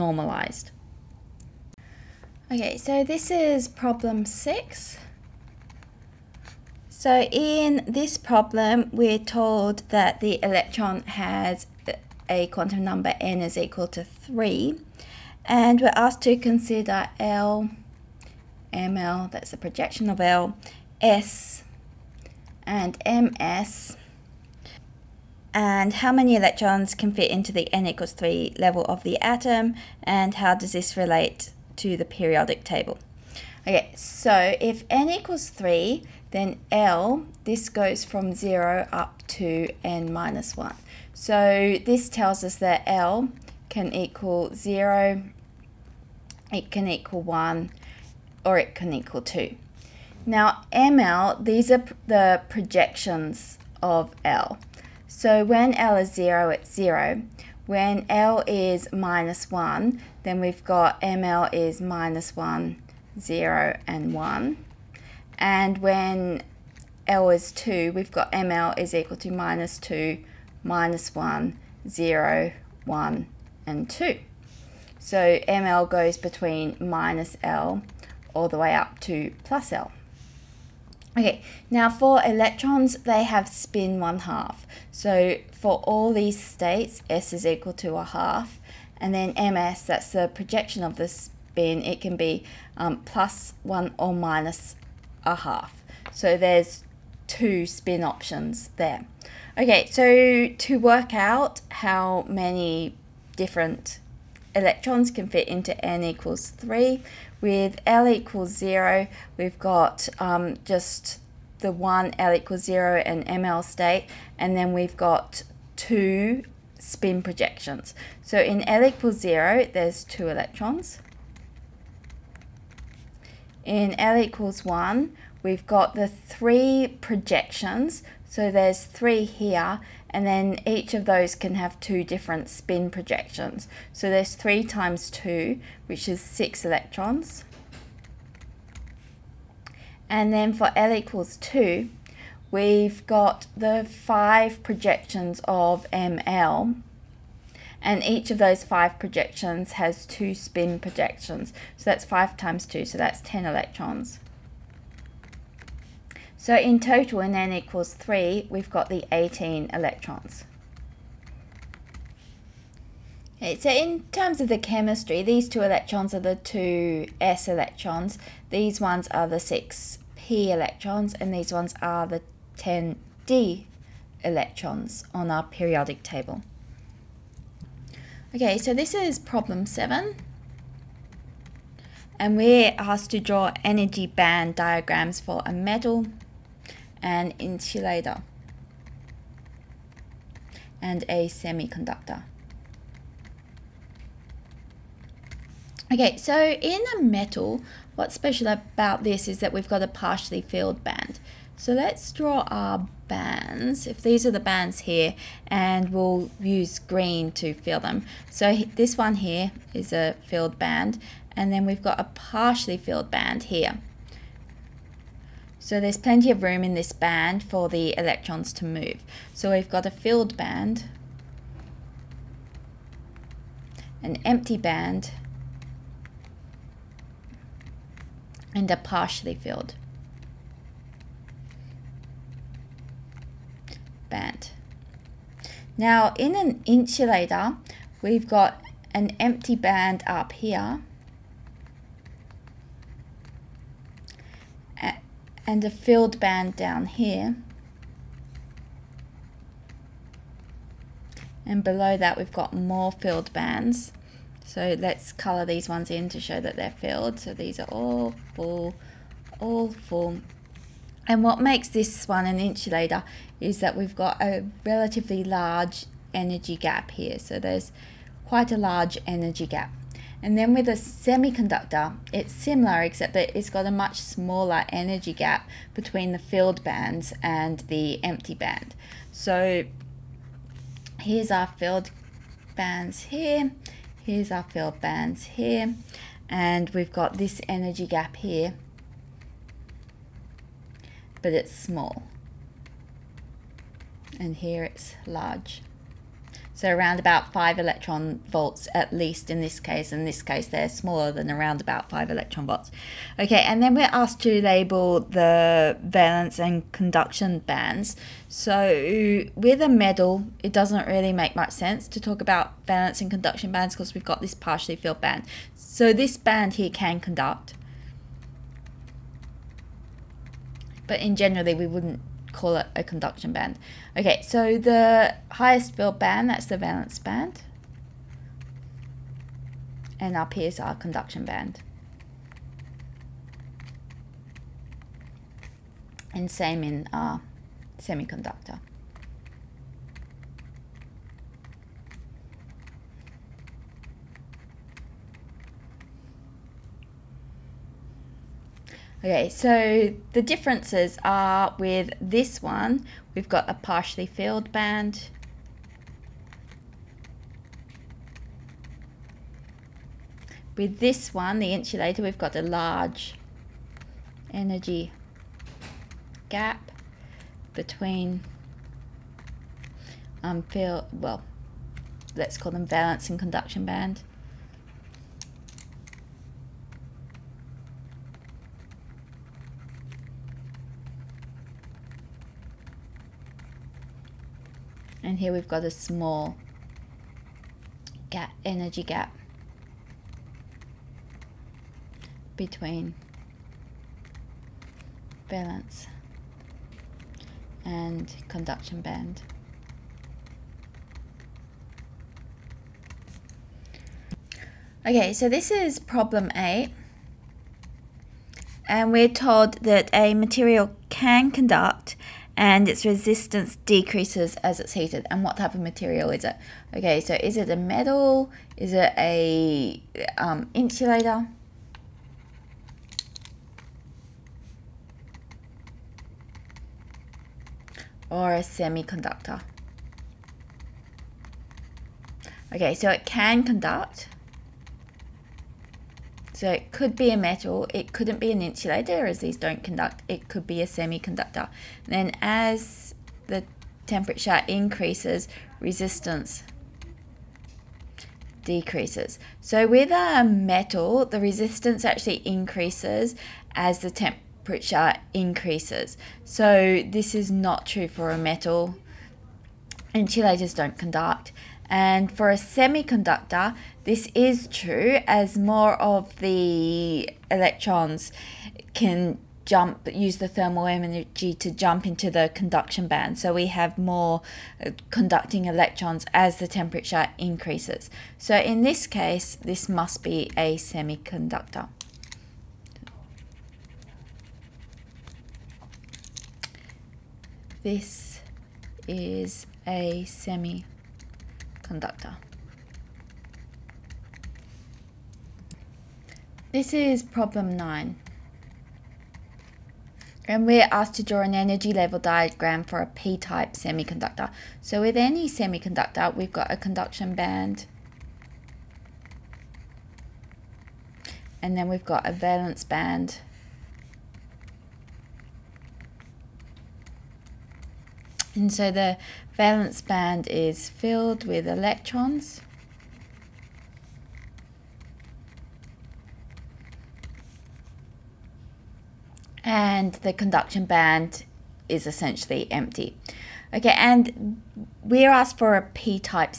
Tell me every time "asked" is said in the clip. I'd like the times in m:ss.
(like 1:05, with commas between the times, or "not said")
0:15, 3:02, 5:03, 8:20, 8:55.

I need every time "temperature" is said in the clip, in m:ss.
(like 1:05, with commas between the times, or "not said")
7:23, 7:33, 7:56.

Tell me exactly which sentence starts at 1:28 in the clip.
And then MS, that's the projection of the spin, it can be um, plus one or minus a half.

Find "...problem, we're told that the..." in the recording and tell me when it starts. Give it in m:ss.
0:08.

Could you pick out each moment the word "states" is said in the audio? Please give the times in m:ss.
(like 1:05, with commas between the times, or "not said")
1:26, 1:53.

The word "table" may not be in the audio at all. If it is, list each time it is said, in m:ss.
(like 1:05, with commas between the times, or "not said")
0:32, 2:56.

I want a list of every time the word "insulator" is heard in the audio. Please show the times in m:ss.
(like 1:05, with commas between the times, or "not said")
3:07, 3:56, 4:22, 6:01, 7:00, 7:18, 7:39.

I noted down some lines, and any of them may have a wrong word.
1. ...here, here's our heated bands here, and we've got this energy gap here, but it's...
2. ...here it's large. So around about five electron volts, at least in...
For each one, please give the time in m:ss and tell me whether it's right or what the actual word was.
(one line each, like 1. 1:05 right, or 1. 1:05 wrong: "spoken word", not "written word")
1. 4:43 wrong: "filled", not "heated"
2. 4:54 right.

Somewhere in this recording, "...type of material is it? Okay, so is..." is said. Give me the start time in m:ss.
6:55.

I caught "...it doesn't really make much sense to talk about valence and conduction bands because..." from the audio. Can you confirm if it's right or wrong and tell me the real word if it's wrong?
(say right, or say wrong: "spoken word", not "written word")
right.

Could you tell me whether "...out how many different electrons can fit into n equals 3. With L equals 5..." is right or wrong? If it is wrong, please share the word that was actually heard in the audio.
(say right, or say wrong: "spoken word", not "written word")
wrong: "0", not "5".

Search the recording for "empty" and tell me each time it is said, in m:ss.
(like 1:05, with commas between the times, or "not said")
3:44, 3:59, 4:38, 8:52.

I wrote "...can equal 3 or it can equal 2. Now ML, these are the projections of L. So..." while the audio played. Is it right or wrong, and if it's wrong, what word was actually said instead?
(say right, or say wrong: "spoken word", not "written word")
wrong: "1", not "3".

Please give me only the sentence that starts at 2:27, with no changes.
And each of those 5 projections has 2 spin projections.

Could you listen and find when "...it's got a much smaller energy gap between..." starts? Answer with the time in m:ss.
4:33.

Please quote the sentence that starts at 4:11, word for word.
And below that we've got more filled bands.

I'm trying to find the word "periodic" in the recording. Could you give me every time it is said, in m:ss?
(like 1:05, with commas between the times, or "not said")
0:32, 2:55.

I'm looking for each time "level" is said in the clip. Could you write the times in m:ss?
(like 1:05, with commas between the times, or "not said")
0:28, 8:21.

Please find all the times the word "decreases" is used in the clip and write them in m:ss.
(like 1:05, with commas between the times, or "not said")
6:53, 7:28.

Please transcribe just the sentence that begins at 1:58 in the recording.
So in L equals 0, there's two electrons.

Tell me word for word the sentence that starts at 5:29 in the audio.
And up here is our conduction band.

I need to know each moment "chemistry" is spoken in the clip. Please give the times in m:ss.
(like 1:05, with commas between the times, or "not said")
2:44.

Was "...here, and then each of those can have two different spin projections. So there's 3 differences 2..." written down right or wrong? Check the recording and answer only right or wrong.
wrong.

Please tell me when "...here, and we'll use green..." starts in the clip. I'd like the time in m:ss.
3:24.